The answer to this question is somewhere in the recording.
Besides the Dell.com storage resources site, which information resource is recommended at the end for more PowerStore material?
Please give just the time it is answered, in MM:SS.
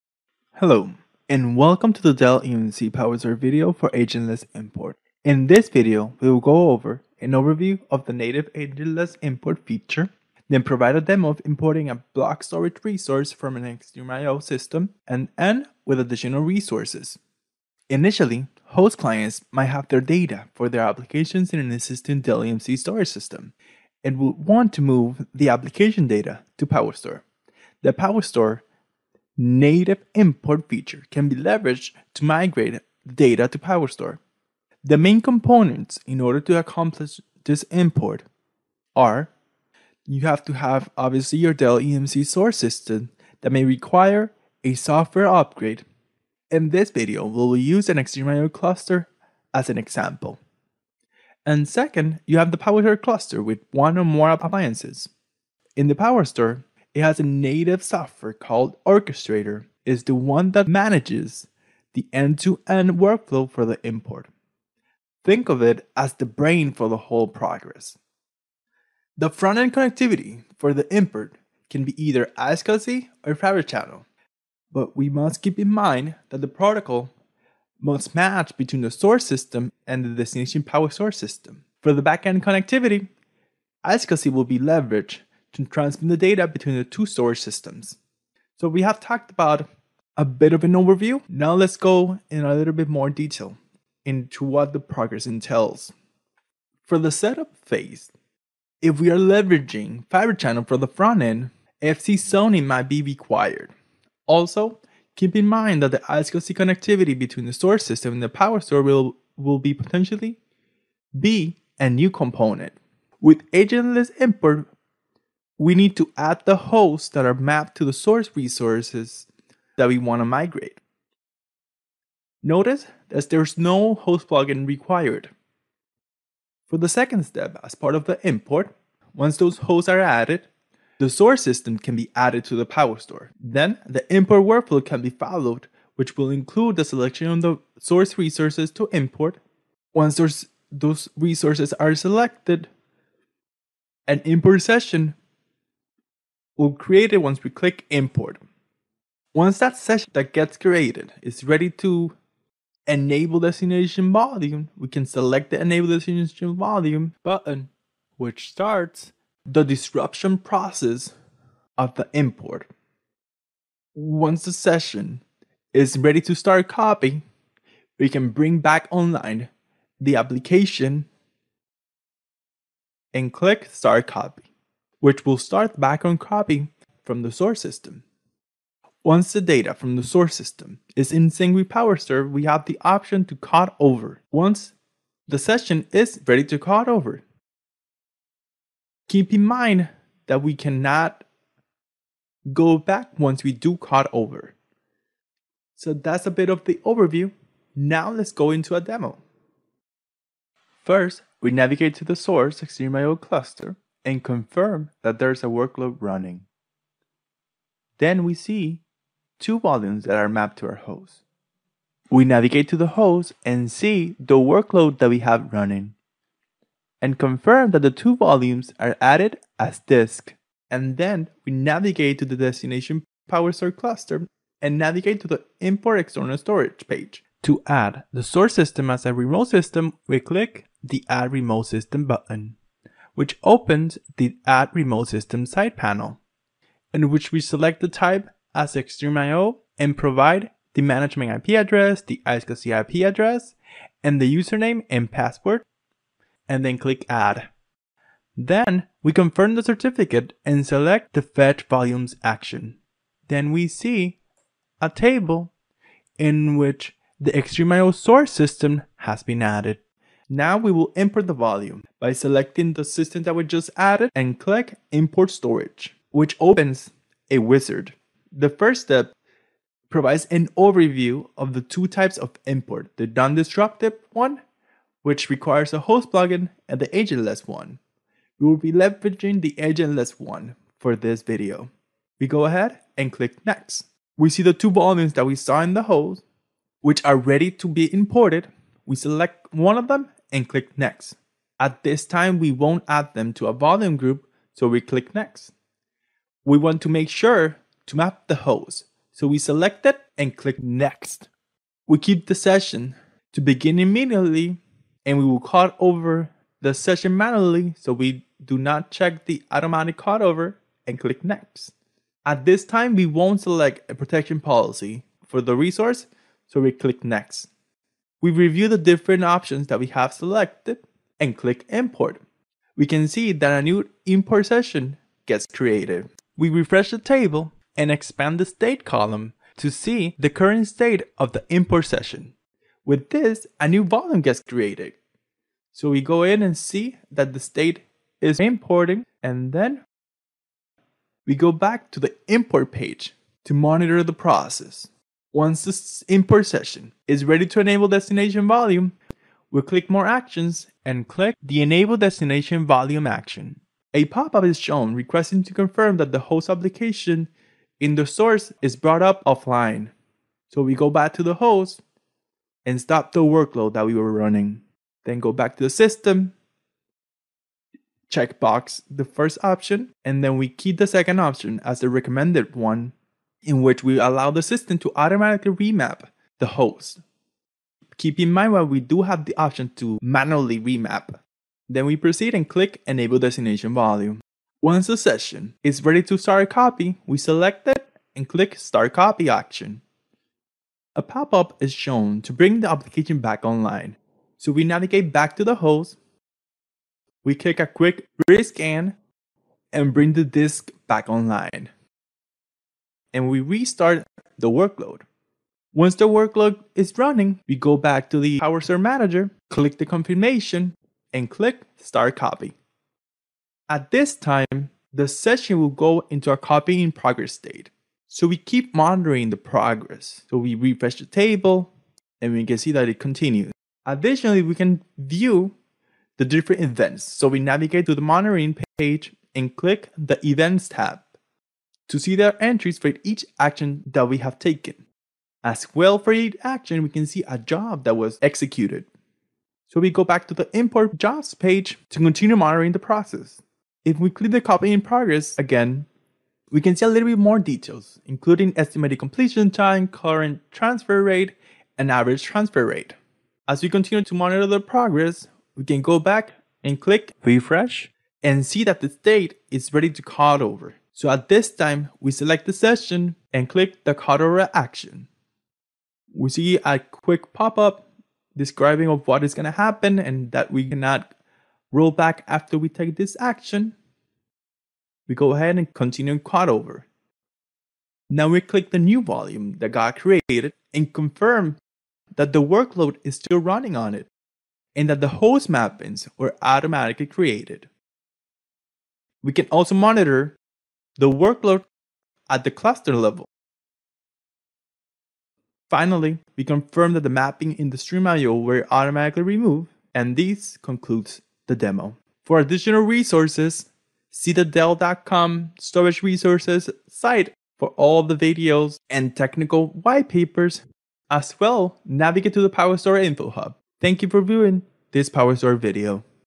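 08:32.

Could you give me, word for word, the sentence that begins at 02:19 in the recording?
Once those resources are selected, an import session will create it once we click import.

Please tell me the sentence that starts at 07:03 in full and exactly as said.
Additionally, we can view the different events.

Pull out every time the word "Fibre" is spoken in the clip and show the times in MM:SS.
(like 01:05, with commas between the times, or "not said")
01:13, 01:40.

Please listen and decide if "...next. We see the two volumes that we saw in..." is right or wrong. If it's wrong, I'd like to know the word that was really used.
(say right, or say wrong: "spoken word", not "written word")
right.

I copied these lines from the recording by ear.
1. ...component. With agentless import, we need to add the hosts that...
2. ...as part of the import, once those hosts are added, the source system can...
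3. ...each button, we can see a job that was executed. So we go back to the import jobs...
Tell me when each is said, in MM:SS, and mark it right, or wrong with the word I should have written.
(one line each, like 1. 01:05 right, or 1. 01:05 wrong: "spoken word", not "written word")
1. 01:52 right
2. 02:07 right
3. 07:16 wrong: "action", not "button".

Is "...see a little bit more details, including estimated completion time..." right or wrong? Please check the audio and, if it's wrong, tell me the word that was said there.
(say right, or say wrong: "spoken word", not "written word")
right.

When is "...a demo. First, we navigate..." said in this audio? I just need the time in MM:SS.
03:18.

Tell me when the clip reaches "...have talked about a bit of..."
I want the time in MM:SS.
01:28.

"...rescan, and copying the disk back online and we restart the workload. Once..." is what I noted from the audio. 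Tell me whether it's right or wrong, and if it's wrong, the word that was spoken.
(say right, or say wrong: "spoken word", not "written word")
wrong: "bring", not "copying".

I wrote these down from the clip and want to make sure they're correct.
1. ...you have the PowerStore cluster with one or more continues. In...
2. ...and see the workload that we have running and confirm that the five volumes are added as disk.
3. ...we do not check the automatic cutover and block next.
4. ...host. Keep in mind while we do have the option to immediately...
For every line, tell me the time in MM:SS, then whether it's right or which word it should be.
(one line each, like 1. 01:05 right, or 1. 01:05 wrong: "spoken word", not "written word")
1. 00:52 wrong: "appliances", not "continues"
2. 03:33 wrong: "two", not "five"
3. 05:07 wrong: "click", not "block"
4. 06:16 wrong: "manually", not "immediately".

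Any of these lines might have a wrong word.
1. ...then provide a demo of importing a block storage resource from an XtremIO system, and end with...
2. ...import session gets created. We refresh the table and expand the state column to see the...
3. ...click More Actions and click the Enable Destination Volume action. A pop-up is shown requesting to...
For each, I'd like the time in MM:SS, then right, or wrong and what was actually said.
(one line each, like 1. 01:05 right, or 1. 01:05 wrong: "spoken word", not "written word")
1. 00:10 right
2. 05:24 right
3. 05:49 right.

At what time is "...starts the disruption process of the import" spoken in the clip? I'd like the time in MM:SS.
02:38.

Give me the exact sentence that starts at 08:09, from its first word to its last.
We can also monitor the workload at the cluster level.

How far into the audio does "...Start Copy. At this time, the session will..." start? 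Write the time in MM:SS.
06:51.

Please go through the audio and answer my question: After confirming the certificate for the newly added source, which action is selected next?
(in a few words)
Fetch Volumes.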